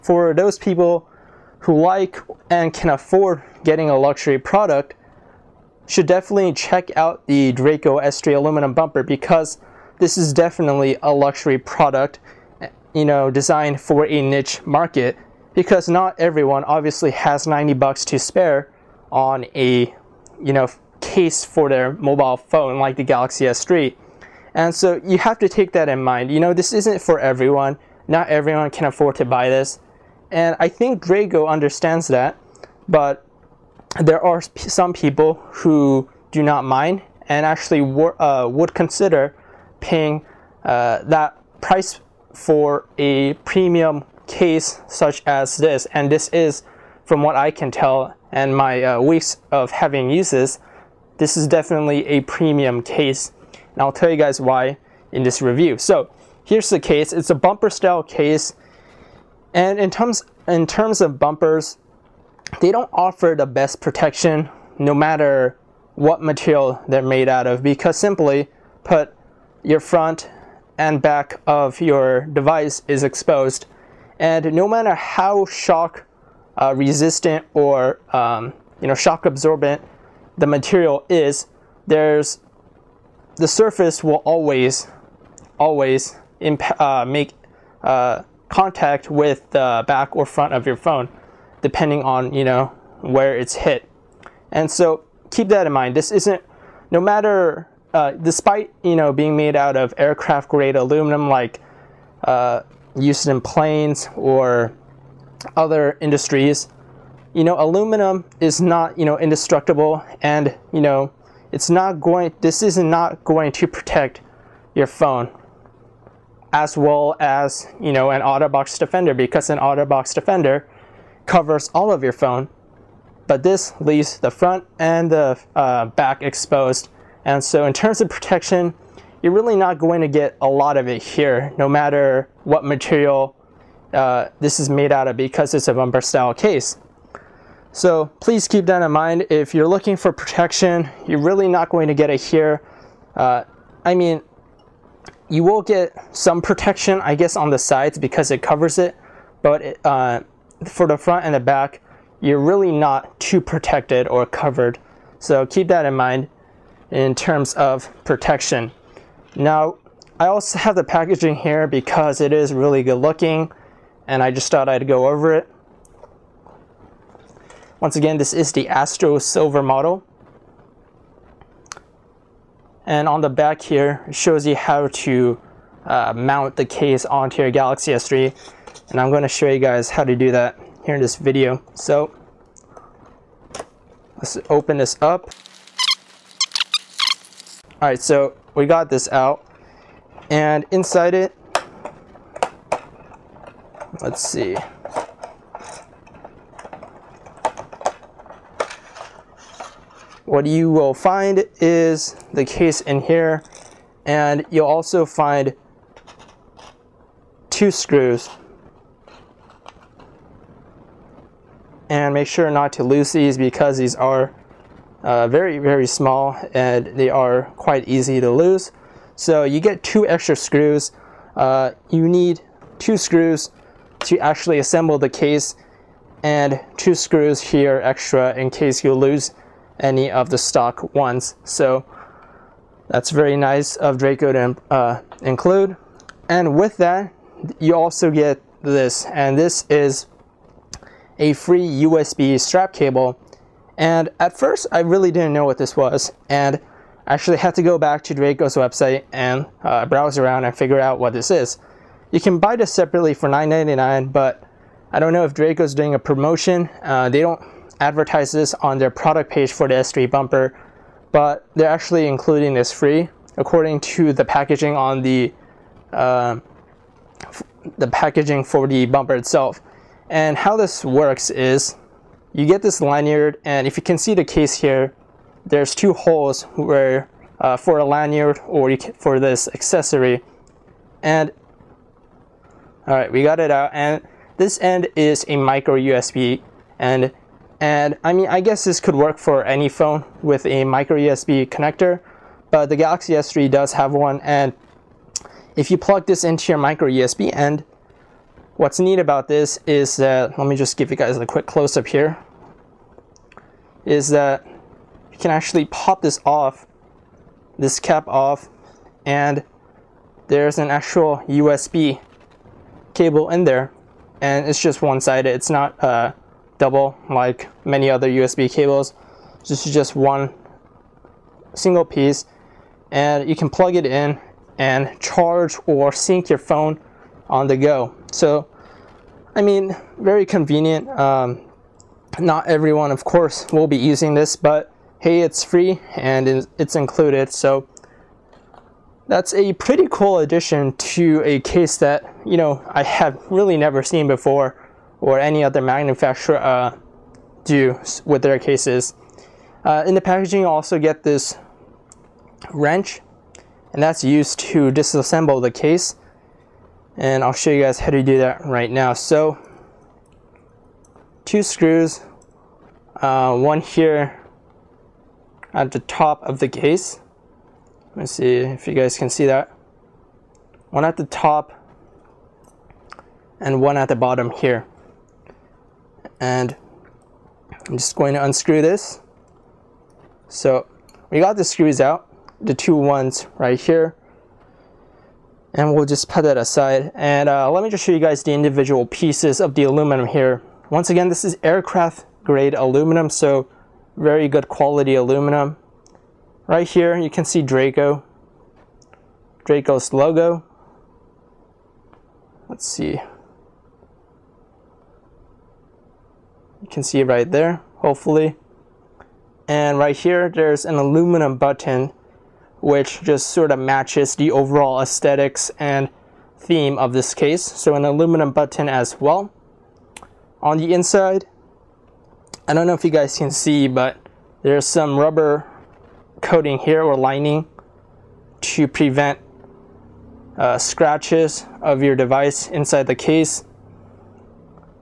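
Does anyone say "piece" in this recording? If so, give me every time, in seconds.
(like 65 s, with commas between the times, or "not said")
321 s, 388 s.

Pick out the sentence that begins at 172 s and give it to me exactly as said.
And on the back here, it shows you how to uh, mount the case onto your Galaxy S3.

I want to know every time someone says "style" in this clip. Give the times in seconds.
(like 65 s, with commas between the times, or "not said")
57 s, 136 s.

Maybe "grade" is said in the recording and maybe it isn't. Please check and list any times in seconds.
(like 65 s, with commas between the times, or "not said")
100 s, 392 s.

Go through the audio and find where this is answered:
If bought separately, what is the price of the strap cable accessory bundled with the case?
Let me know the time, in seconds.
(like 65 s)
253 s.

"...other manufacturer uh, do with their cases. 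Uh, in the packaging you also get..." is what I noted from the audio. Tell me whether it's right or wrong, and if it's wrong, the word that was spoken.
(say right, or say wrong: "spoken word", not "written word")
right.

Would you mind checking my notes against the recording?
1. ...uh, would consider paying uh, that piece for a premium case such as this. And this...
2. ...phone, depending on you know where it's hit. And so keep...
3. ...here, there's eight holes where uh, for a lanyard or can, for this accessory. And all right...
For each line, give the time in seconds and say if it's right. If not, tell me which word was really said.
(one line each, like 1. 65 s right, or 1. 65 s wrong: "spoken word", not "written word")
1. 38 s wrong: "price", not "piece"
2. 90 s right
3. 274 s wrong: "two", not "eight".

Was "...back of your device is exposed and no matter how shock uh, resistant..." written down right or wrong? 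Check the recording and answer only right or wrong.
right.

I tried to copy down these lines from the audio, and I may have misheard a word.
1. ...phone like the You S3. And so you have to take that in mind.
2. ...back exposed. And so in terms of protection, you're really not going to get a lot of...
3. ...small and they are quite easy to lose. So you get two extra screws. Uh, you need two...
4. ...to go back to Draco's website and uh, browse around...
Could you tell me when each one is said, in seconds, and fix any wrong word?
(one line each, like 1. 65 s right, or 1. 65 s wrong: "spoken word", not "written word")
1. 22 s wrong: "Galaxy", not "You"
2. 125 s right
3. 215 s right
4. 247 s right.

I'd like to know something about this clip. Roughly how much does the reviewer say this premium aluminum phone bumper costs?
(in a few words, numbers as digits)
90 bucks.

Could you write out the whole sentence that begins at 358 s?
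So two screws, uh, one here at the top of the case.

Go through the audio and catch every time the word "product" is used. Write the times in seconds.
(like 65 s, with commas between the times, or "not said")
4 s, 11 s, 258 s.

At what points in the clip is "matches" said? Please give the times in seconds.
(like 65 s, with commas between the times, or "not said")
413 s.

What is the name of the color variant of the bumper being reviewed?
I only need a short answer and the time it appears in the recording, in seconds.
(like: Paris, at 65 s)
Astro Silver, at 168 s.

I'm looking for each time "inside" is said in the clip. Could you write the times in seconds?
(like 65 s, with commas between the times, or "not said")
190 s, 420 s, 432 s.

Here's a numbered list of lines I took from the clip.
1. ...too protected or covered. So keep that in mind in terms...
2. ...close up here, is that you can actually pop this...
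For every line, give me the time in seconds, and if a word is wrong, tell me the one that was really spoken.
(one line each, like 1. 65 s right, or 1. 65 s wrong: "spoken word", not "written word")
1. 153 s right
2. 301 s right.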